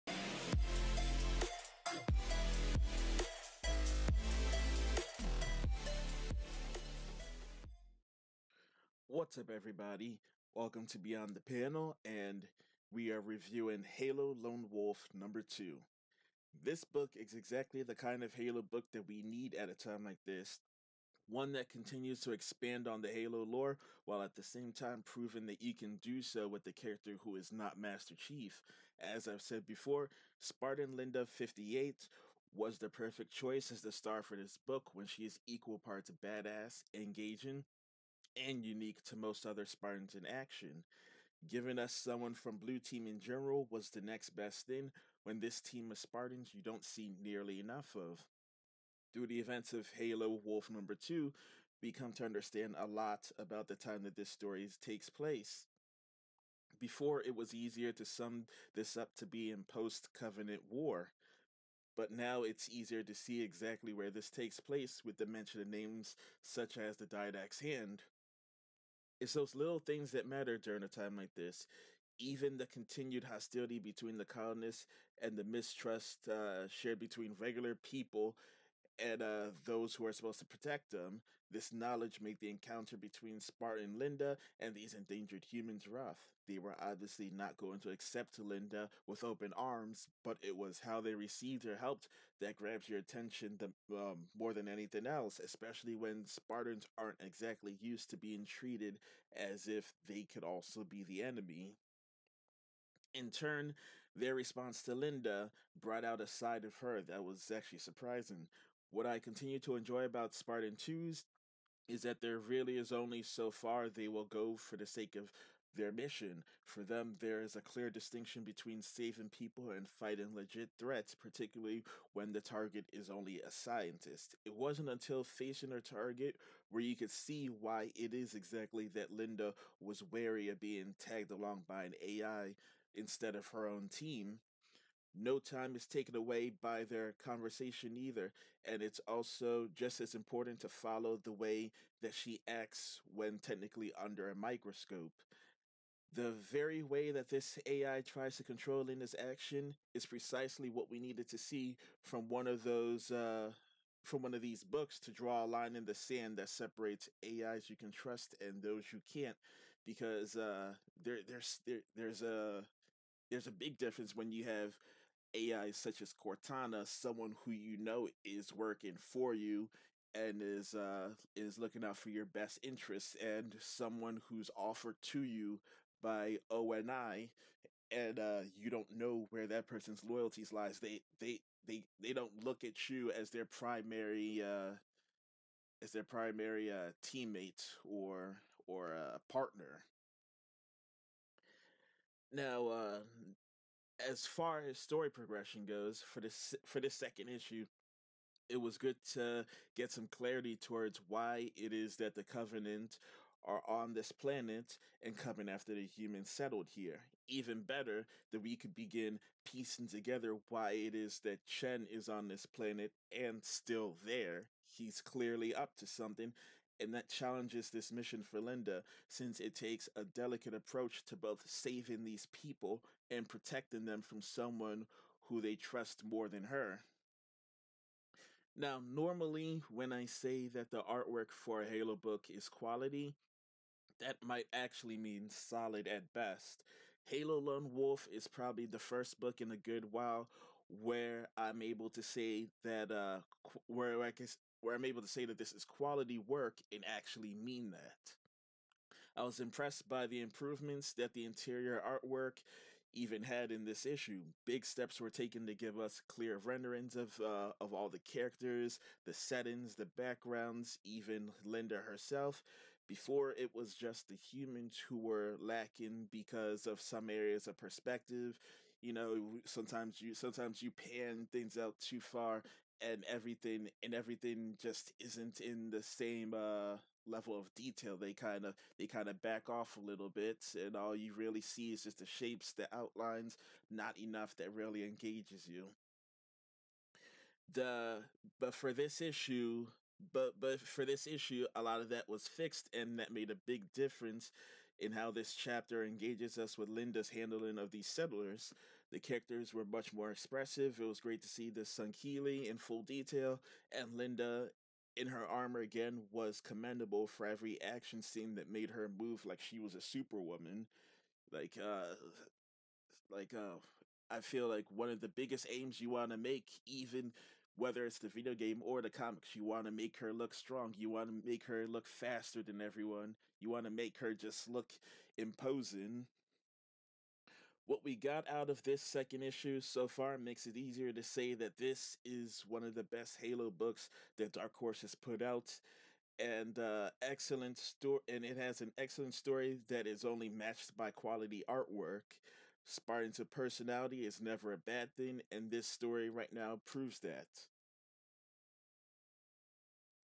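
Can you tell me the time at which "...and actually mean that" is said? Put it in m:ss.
4:06.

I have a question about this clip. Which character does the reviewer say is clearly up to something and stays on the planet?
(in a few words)
Chen.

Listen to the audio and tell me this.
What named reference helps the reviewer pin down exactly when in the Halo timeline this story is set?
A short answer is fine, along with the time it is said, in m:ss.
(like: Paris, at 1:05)
the Didact's Hand, at 1:06.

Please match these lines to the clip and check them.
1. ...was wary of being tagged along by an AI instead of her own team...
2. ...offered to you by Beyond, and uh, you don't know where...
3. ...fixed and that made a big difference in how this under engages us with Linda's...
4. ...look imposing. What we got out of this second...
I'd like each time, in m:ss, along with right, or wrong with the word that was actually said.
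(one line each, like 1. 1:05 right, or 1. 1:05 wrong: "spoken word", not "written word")
1. 2:09 right
2. 2:54 wrong: "ONI", not "Beyond"
3. 4:52 wrong: "chapter", not "under"
4. 5:24 right.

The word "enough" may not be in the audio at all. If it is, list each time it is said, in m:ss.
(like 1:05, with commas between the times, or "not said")
0:47, 4:43.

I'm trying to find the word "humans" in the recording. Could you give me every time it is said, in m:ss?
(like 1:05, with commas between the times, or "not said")
1:25, 3:25, 4:24.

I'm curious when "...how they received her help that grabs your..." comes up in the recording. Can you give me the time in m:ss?
1:30.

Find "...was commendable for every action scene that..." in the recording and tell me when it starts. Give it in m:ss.
5:06.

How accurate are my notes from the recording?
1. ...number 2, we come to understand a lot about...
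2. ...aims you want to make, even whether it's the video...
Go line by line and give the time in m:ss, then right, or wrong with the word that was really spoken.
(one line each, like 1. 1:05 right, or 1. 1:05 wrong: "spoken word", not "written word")
1. 0:50 right
2. 5:15 right.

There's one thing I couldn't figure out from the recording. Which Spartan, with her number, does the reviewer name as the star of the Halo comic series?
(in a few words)
Linda 58.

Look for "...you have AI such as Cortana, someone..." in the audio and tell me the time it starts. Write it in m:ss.
2:44.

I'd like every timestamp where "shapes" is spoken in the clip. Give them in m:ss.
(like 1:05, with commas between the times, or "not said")
4:42.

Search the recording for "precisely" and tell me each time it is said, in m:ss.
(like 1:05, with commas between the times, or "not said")
2:30.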